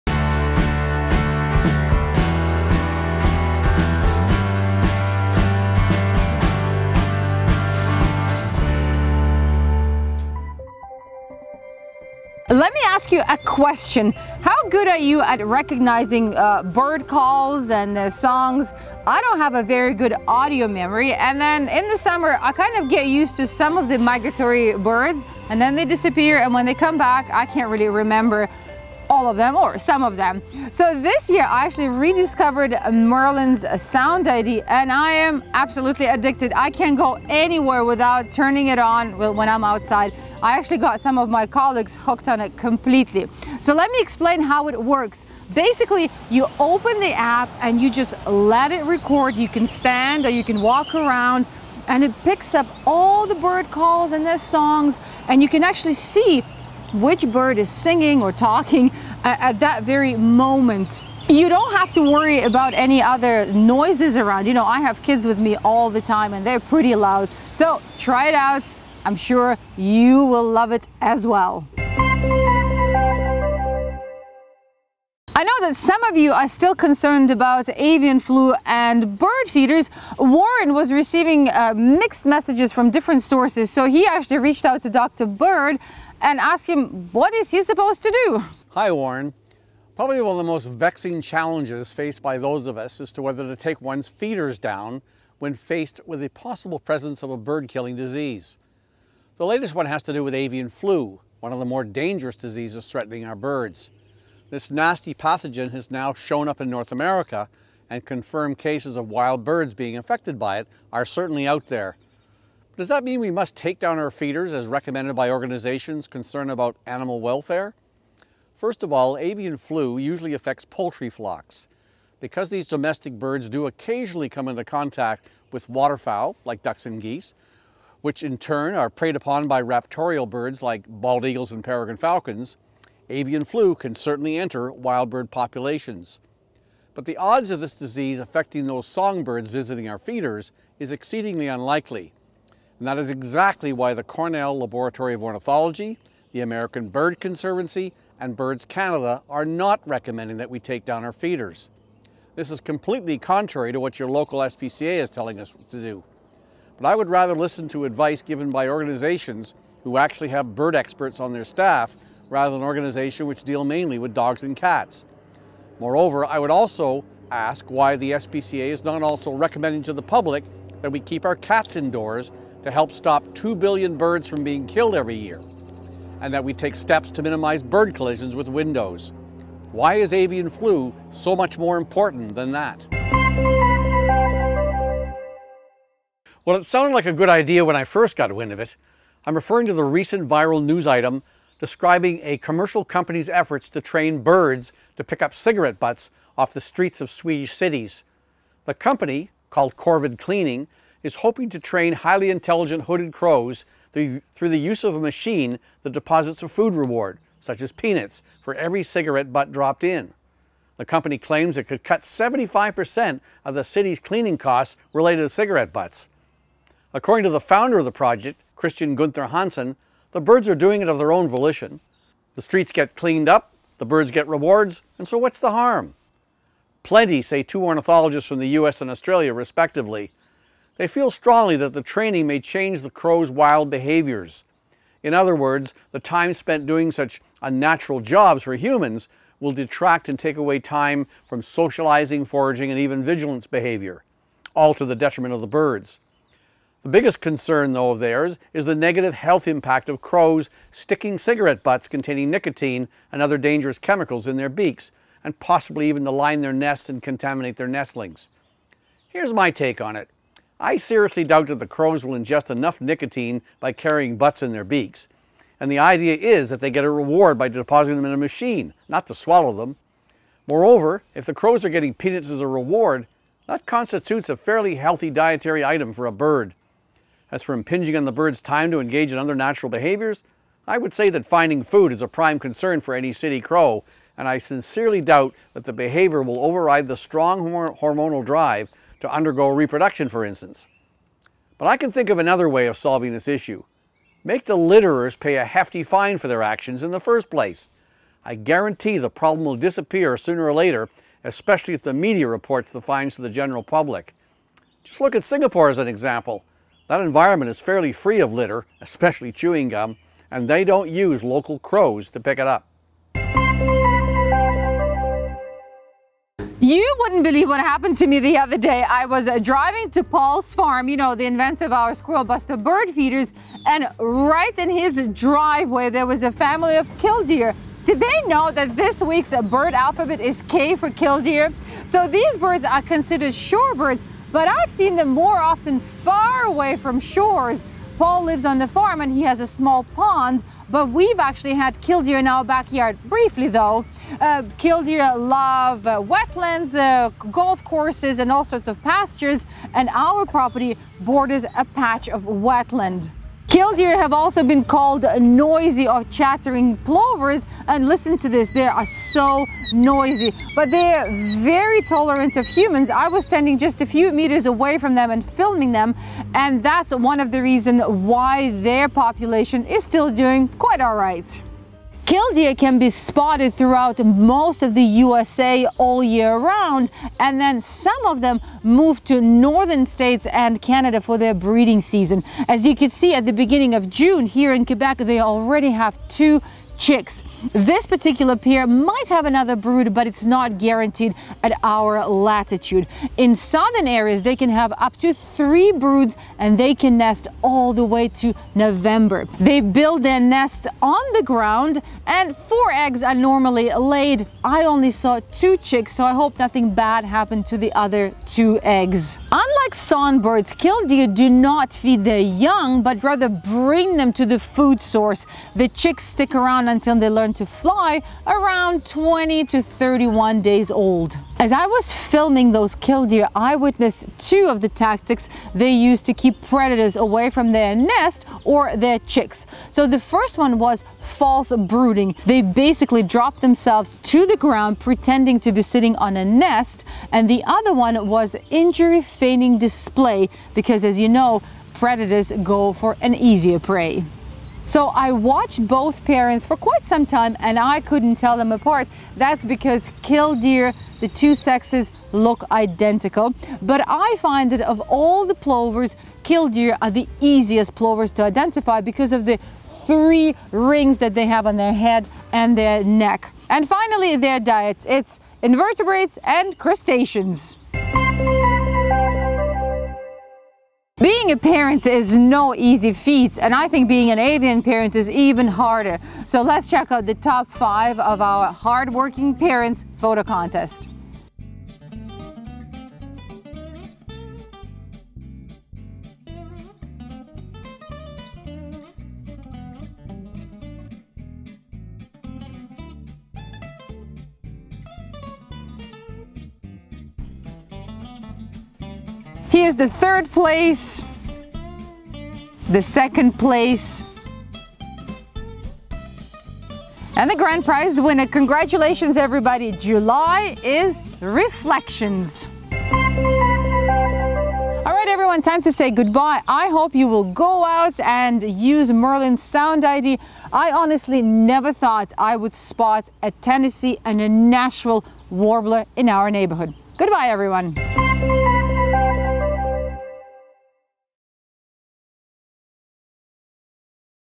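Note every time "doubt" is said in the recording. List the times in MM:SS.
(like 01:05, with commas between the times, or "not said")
04:21, 04:45.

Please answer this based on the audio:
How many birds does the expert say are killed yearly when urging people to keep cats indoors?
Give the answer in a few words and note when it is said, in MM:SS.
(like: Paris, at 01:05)
2 billion, at 02:53.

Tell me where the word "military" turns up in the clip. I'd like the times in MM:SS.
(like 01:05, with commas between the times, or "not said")
not said.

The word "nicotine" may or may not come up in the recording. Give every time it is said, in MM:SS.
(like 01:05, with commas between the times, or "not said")
04:12, 04:22.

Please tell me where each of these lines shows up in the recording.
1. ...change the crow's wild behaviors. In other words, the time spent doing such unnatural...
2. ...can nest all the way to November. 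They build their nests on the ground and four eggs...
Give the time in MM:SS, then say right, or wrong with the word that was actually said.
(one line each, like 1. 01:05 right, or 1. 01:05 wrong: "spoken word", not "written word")
1. 03:52 right
2. 06:36 right.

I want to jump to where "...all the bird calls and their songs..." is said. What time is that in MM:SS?
00:52.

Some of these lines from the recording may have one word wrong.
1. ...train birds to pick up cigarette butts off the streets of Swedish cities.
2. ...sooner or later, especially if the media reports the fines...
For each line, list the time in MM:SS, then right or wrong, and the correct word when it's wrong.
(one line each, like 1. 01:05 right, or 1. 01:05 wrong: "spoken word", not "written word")
1. 03:13 right
2. 05:00 right.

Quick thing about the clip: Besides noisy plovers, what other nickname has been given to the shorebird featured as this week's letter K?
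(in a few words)
chattering plovers.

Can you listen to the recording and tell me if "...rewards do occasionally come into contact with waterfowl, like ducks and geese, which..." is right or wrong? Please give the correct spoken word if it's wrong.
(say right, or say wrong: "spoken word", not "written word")
wrong: "birds", not "rewards".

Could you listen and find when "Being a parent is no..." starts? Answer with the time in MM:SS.
07:51.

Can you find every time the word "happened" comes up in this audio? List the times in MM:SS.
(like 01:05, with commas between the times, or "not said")
05:17, 06:47.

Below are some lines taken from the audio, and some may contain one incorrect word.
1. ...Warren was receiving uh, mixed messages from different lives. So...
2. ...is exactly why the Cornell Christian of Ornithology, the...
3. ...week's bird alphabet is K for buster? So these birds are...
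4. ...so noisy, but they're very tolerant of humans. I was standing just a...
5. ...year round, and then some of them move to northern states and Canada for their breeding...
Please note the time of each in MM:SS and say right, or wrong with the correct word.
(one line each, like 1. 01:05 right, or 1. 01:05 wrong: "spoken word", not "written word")
1. 01:20 wrong: "sources", not "lives"
2. 02:22 wrong: "Laboratory", not "Christian"
3. 05:29 wrong: "killdeer", not "buster"
4. 05:59 right
5. 06:16 right.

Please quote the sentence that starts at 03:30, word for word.
The company claims it could cut 75% of the city's cleaning costs related to cigarette butts.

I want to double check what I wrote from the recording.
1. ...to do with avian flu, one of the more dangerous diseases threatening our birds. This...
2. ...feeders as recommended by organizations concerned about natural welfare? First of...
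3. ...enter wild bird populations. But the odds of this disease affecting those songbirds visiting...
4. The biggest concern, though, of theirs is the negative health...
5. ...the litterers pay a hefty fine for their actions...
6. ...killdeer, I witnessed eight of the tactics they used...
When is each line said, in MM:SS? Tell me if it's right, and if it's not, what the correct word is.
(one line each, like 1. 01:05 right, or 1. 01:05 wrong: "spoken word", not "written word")
1. 01:40 right
2. 01:54 wrong: "animal", not "natural"
3. 02:14 right
4. 04:06 right
5. 04:54 right
6. 07:02 wrong: "two", not "eight".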